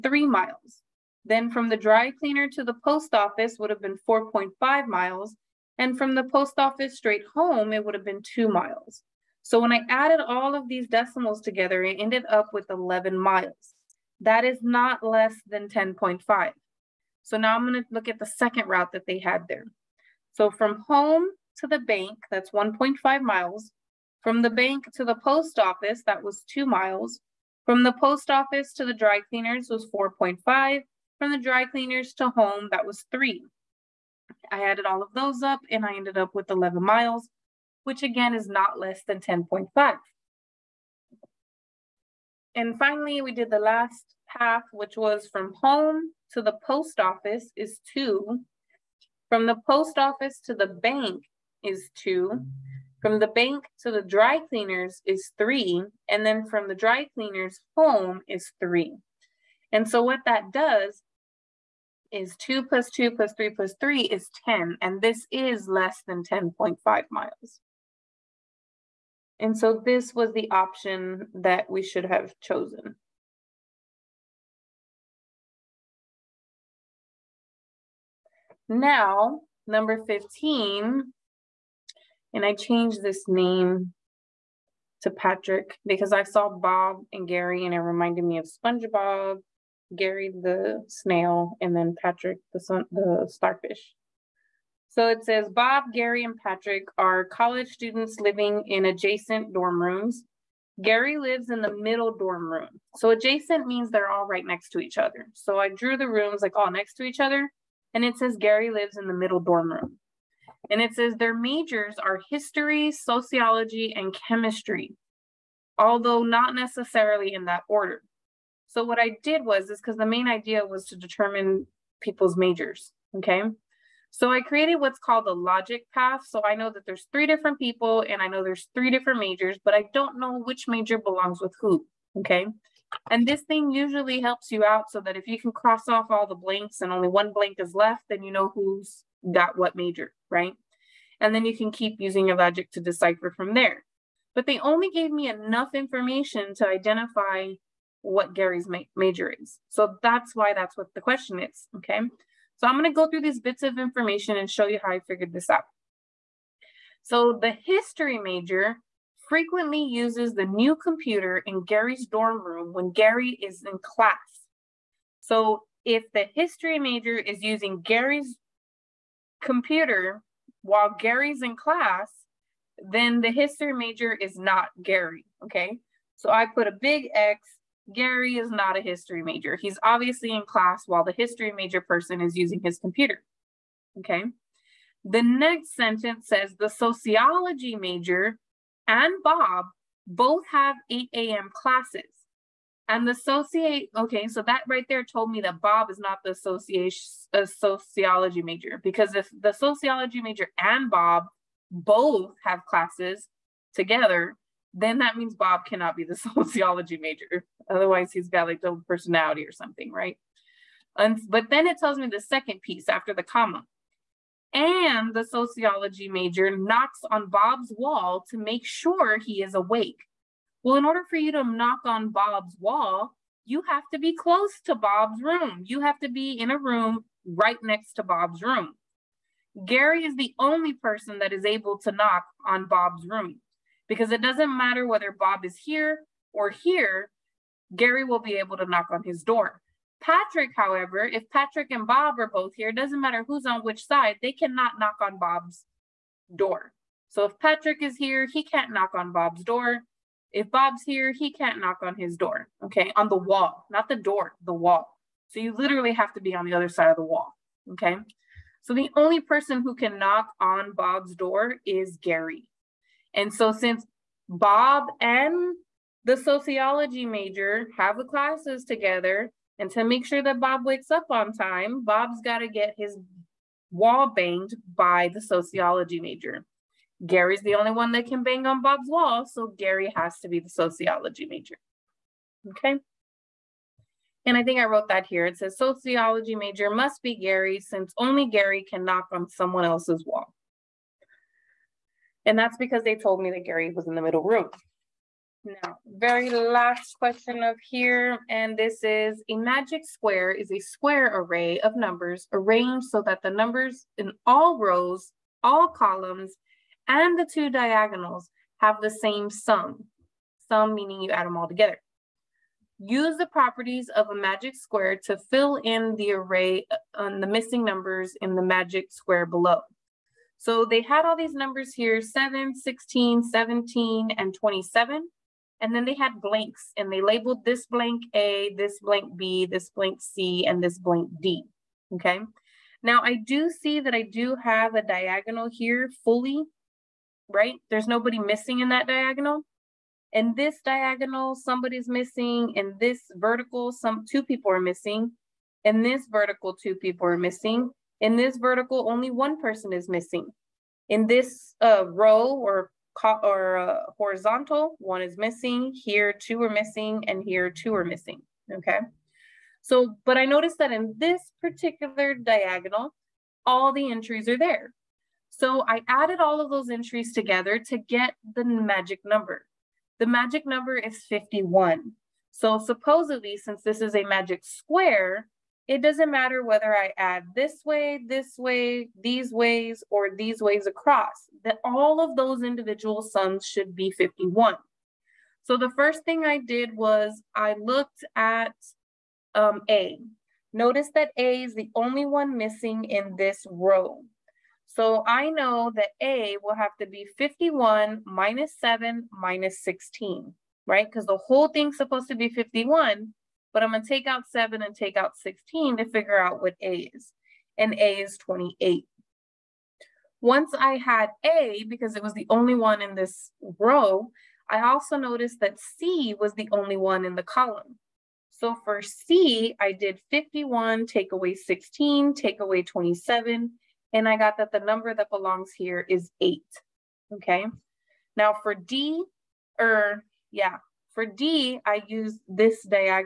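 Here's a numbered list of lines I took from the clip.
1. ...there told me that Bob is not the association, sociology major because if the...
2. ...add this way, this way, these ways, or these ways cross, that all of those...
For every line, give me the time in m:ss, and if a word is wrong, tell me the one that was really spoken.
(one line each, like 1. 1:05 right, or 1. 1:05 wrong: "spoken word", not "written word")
1. 3:14 right
2. 6:16 wrong: "across", not "cross".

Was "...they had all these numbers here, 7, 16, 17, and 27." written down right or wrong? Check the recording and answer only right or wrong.
right.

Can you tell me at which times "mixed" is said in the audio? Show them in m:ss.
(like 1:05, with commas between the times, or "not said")
not said.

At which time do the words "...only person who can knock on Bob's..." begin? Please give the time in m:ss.
4:18.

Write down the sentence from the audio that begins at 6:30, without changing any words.
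Notice that A is the only one missing in this row.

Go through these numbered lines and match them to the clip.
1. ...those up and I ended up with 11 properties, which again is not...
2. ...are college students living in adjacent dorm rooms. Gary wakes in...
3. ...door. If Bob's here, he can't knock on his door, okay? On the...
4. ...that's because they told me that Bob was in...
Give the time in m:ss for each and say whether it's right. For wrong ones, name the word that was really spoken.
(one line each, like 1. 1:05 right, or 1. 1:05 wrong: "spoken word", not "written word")
1. 0:35 wrong: "miles", not "properties"
2. 1:36 wrong: "lives", not "wakes"
3. 4:09 right
4. 4:52 wrong: "Gary", not "Bob".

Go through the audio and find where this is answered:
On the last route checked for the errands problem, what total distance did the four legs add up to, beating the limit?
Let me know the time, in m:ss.
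1:04.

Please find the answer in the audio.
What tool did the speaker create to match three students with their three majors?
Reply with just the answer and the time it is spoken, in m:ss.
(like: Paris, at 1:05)
logic path, at 2:05.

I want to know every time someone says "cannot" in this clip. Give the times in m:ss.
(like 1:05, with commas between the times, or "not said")
3:25, 4:04.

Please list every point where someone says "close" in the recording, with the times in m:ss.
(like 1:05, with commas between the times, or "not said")
3:44.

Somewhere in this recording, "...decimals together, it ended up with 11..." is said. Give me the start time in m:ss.
0:10.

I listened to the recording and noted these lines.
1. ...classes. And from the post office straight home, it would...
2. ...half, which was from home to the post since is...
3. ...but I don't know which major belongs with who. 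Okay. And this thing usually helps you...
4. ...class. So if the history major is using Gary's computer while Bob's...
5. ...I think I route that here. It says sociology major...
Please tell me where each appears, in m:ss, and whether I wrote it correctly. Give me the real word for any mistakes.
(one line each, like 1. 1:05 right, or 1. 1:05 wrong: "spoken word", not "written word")
1. 0:04 wrong: "miles", not "classes"
2. 0:44 wrong: "office", not "since"
3. 2:09 right
4. 2:43 wrong: "Gary", not "Bob"
5. 4:44 wrong: "wrote", not "route".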